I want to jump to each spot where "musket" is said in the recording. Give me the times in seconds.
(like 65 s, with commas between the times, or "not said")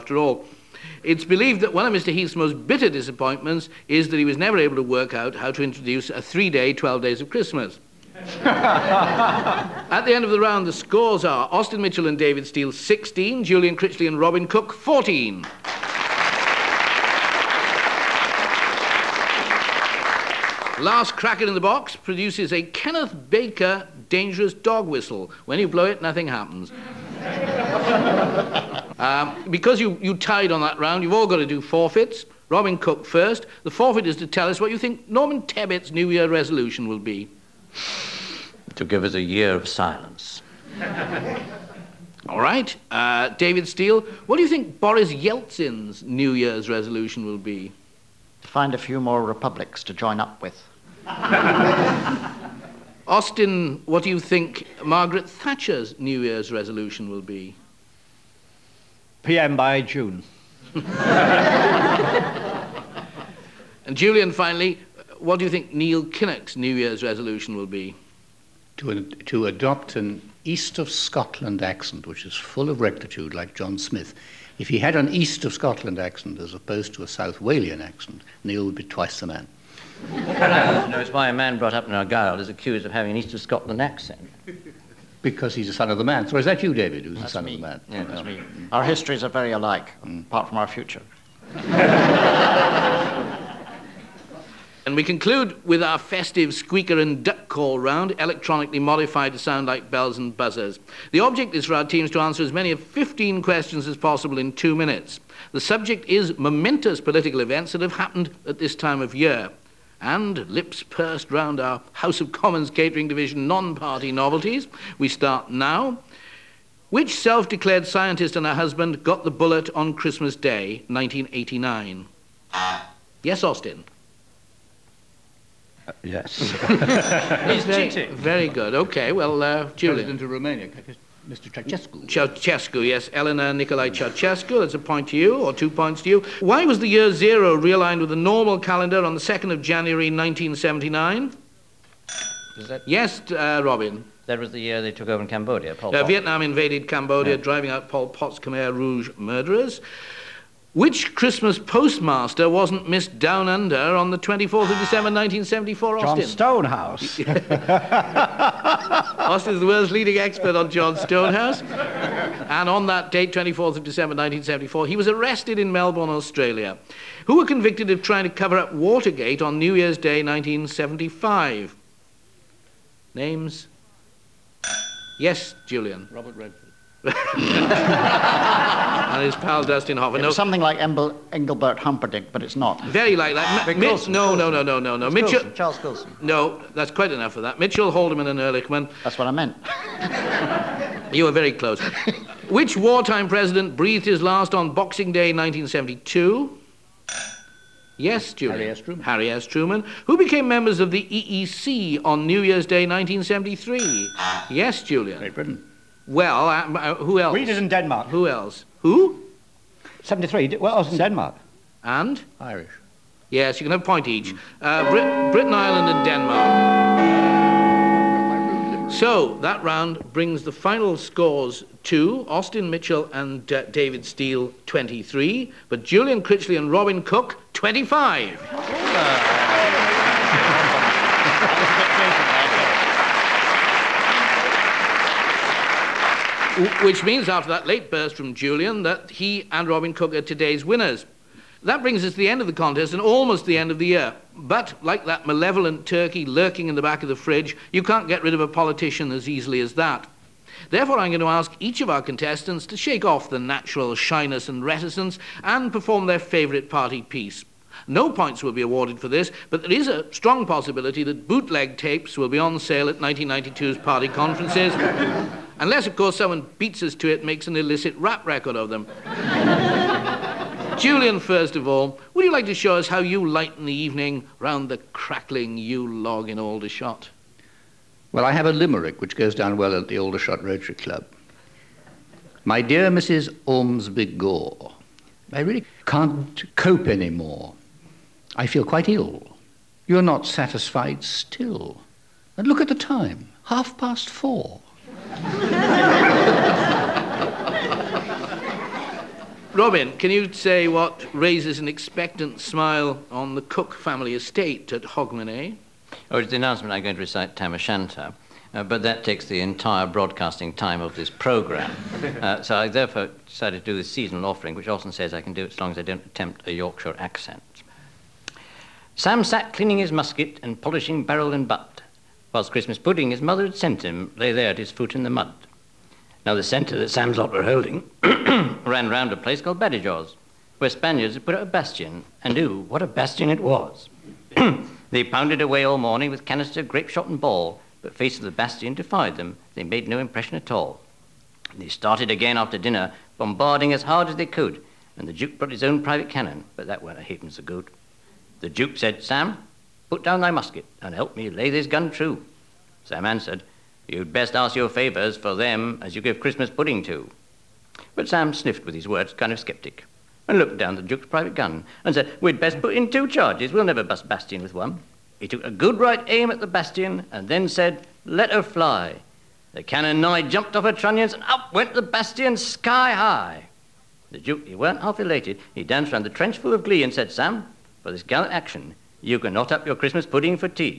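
319 s, 350 s.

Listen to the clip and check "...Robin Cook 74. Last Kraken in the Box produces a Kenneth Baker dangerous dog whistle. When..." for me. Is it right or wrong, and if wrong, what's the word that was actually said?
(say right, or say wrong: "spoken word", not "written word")
wrong: "14", not "74".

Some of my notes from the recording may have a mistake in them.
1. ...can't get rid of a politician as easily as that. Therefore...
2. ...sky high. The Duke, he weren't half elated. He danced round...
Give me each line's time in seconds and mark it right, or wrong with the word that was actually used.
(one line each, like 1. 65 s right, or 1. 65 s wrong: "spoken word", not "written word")
1. 247 s right
2. 372 s right.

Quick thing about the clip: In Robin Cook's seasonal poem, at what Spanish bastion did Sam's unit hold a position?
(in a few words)
Badajoz.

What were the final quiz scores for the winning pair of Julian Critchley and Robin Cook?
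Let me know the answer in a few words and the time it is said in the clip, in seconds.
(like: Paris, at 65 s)
25, at 227 s.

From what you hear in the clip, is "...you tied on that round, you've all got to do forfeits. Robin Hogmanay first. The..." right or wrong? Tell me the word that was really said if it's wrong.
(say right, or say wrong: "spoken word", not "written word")
wrong: "Cook", not "Hogmanay".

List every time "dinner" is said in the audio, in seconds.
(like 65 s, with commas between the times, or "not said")
342 s.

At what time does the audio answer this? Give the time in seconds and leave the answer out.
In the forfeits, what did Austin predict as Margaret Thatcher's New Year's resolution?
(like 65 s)
59 s.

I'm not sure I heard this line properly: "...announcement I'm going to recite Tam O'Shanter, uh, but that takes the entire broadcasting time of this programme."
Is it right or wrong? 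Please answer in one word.
right.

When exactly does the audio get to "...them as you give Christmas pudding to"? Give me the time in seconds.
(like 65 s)
355 s.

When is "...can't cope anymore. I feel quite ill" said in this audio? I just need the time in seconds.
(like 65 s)
285 s.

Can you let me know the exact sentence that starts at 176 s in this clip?
Robert Redford and his pal Dustin Hoffman.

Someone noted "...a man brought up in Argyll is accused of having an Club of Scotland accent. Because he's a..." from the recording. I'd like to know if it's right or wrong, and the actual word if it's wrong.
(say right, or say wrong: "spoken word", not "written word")
wrong: "East", not "Club".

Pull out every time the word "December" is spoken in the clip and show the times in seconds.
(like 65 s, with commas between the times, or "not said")
154 s, 163 s.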